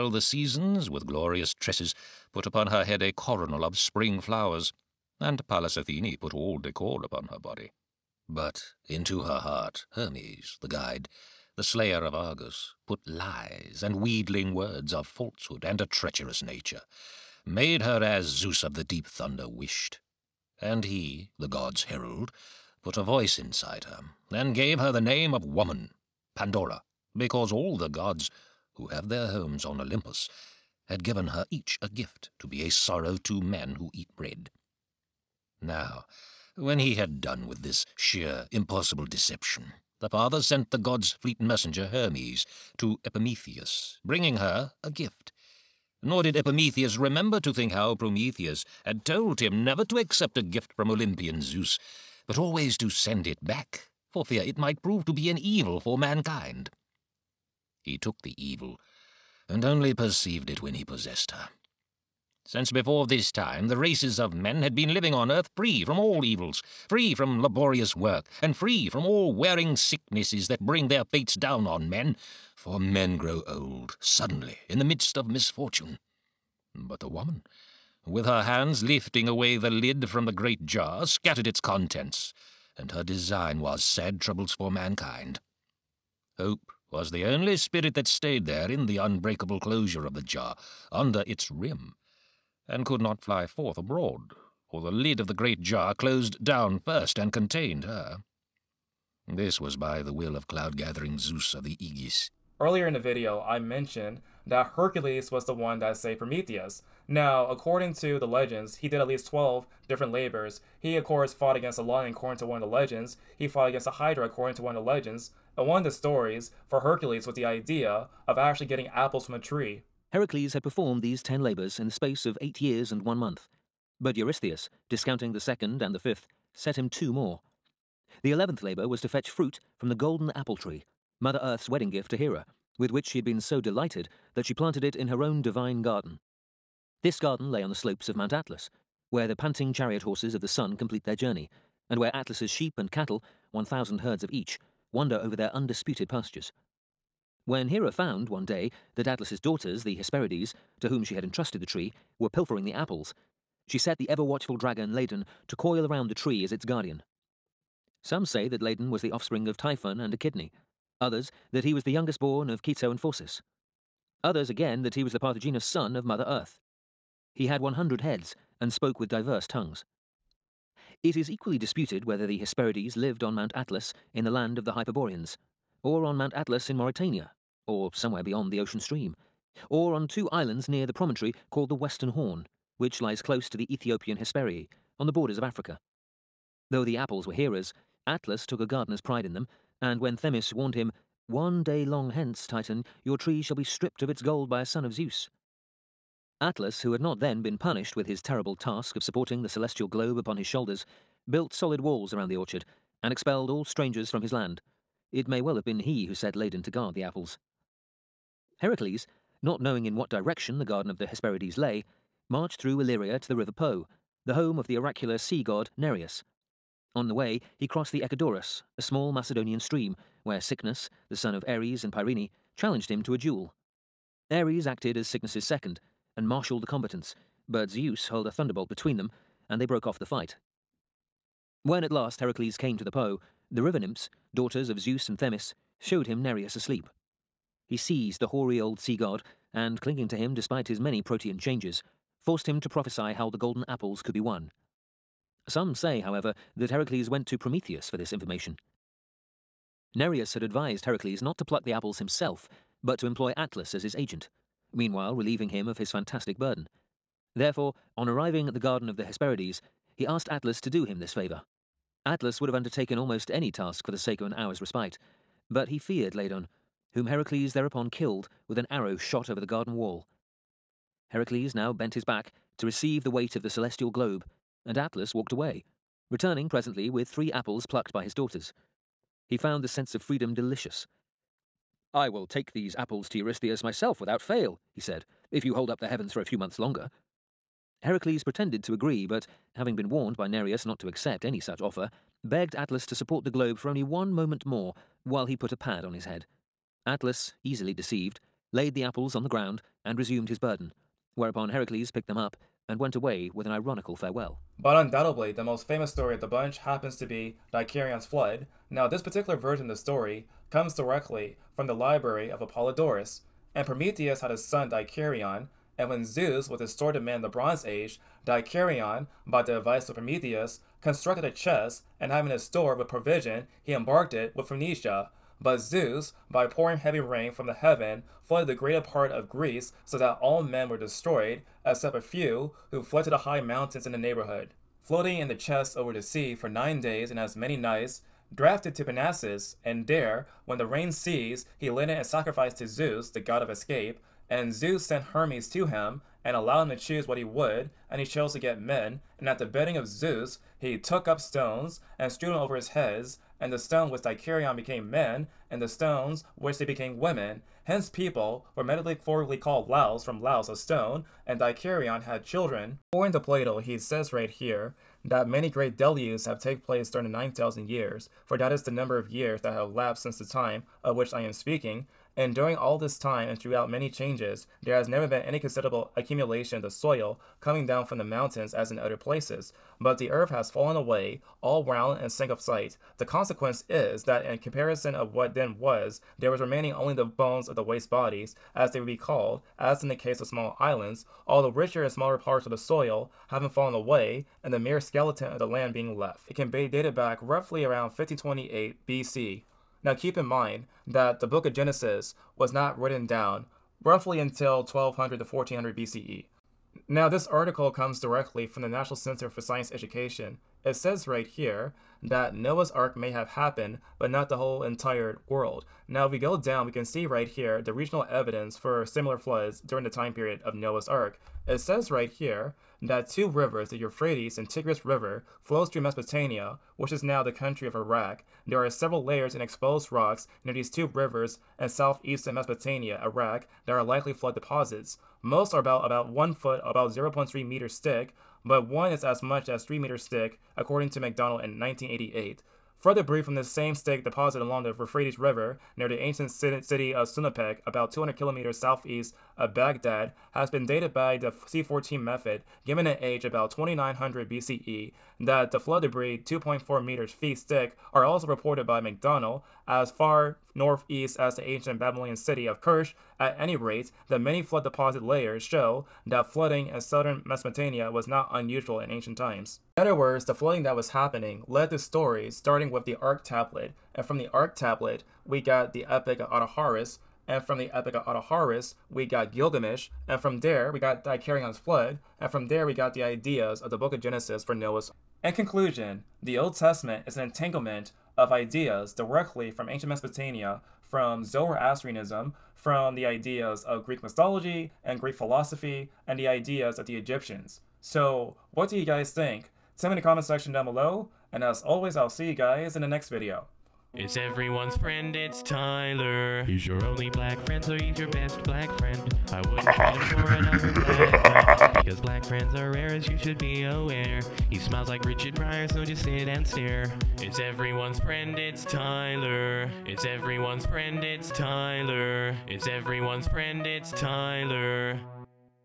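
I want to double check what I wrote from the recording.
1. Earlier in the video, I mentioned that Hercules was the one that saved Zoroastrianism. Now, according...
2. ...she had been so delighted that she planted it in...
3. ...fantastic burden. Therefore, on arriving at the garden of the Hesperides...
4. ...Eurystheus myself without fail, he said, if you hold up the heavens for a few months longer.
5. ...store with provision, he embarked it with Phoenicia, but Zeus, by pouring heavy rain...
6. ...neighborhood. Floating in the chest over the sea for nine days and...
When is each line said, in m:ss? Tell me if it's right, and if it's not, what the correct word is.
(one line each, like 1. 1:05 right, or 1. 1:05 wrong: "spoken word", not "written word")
1. 1:42 wrong: "Prometheus", not "Zoroastrianism"
2. 2:13 right
3. 4:15 right
4. 4:43 right
5. 5:22 right
6. 5:33 right.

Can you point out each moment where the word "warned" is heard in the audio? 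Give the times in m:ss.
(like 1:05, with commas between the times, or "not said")
3:10, 4:49.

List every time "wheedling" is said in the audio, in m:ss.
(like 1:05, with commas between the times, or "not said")
0:14.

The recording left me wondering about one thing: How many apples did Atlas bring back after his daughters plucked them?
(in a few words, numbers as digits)
3.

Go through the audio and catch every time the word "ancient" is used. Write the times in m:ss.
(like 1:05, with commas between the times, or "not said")
7:25, 7:41, 7:48, 8:09.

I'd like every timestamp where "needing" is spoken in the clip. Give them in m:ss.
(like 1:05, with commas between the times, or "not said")
not said.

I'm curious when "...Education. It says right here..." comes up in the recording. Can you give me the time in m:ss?
6:49.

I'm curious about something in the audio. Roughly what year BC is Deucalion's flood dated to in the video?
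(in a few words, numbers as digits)
1528 BC.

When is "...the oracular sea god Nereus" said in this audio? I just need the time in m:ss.
3:34.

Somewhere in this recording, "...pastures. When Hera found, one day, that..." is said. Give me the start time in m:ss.
2:26.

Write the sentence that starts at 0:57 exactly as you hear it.
He took the evil, and only perceived it when he possessed her.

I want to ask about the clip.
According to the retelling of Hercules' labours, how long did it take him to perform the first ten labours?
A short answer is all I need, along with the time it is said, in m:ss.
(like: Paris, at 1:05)
8 years and 1 month, at 2:02.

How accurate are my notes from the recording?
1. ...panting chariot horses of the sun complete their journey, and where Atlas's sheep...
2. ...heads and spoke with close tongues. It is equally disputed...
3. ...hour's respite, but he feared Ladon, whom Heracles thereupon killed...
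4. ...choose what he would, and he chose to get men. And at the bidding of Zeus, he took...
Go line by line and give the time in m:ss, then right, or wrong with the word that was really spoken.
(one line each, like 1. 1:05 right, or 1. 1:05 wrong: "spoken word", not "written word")
1. 2:19 right
2. 2:48 wrong: "diverse", not "close"
3. 4:24 right
4. 5:46 right.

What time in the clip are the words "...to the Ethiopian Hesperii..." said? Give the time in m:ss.
3:03.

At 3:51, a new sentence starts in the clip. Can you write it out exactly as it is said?
When at last Heracles came to the Po, the river nymphs, daughters of Zeus and Themis, showed him Nereus asleep.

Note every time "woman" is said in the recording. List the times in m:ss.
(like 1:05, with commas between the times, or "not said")
0:25, 1:17.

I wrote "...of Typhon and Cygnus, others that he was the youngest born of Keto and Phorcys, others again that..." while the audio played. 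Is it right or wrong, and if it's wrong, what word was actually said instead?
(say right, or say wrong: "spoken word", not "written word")
wrong: "Echidne", not "Cygnus".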